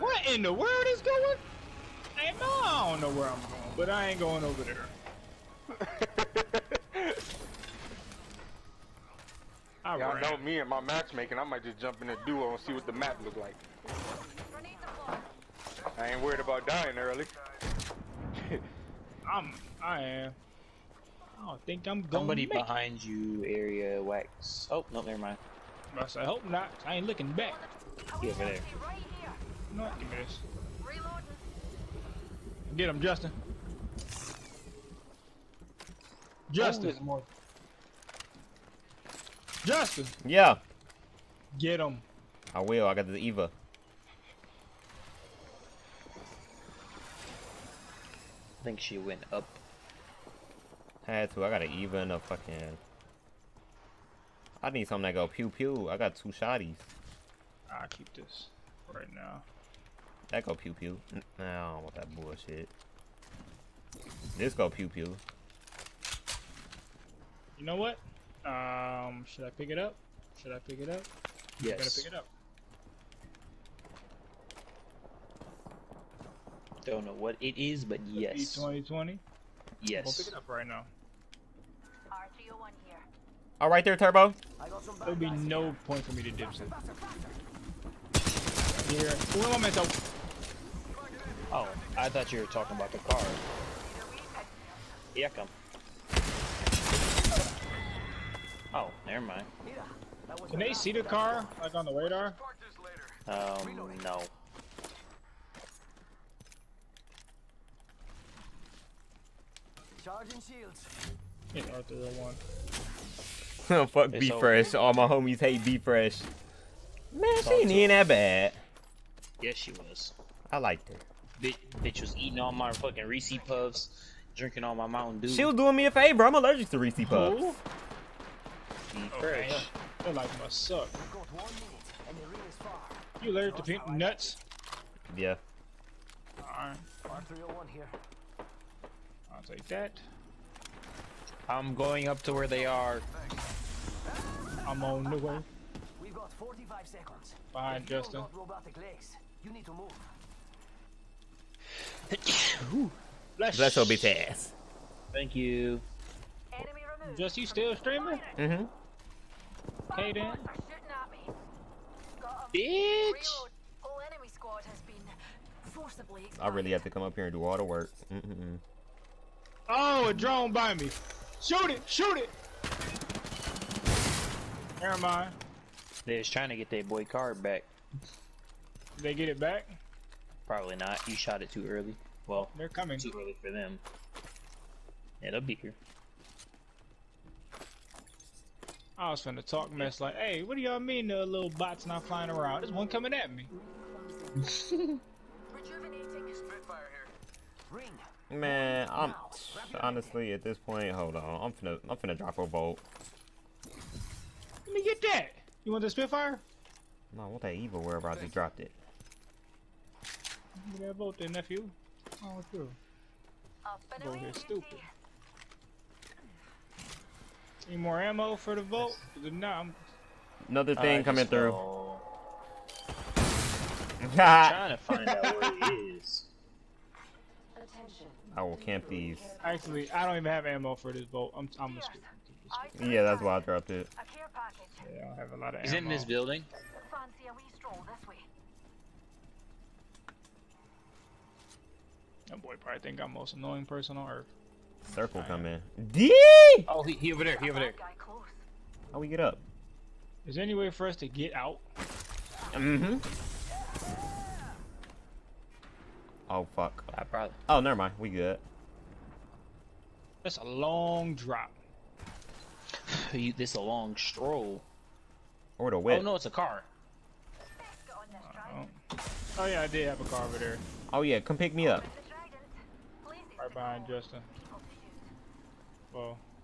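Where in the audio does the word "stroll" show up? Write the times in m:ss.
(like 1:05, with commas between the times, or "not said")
3:57, 4:23.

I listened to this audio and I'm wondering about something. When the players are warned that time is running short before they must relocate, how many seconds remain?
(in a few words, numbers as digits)
45.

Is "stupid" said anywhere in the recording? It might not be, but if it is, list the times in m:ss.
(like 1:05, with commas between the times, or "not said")
3:34, 3:51.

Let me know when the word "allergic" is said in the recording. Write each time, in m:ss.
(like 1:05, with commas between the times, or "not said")
2:06, 2:13.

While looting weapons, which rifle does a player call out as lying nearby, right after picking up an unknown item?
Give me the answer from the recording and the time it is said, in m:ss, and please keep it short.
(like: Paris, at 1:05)
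R301, at 1:22.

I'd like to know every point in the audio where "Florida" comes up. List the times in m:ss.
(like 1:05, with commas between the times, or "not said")
not said.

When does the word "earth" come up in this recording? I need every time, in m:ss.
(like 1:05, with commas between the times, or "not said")
4:04.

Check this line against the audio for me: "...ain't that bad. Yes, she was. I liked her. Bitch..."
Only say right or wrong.
right.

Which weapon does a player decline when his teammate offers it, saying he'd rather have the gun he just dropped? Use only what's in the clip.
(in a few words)
Spitfire.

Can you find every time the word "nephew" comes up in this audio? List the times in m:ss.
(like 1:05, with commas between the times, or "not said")
3:31.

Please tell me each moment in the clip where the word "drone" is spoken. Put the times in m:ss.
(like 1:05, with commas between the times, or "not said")
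2:50.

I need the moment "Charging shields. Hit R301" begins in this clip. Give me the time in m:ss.
1:50.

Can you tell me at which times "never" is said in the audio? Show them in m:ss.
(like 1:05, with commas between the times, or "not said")
0:25, 1:39, 2:54, 4:17.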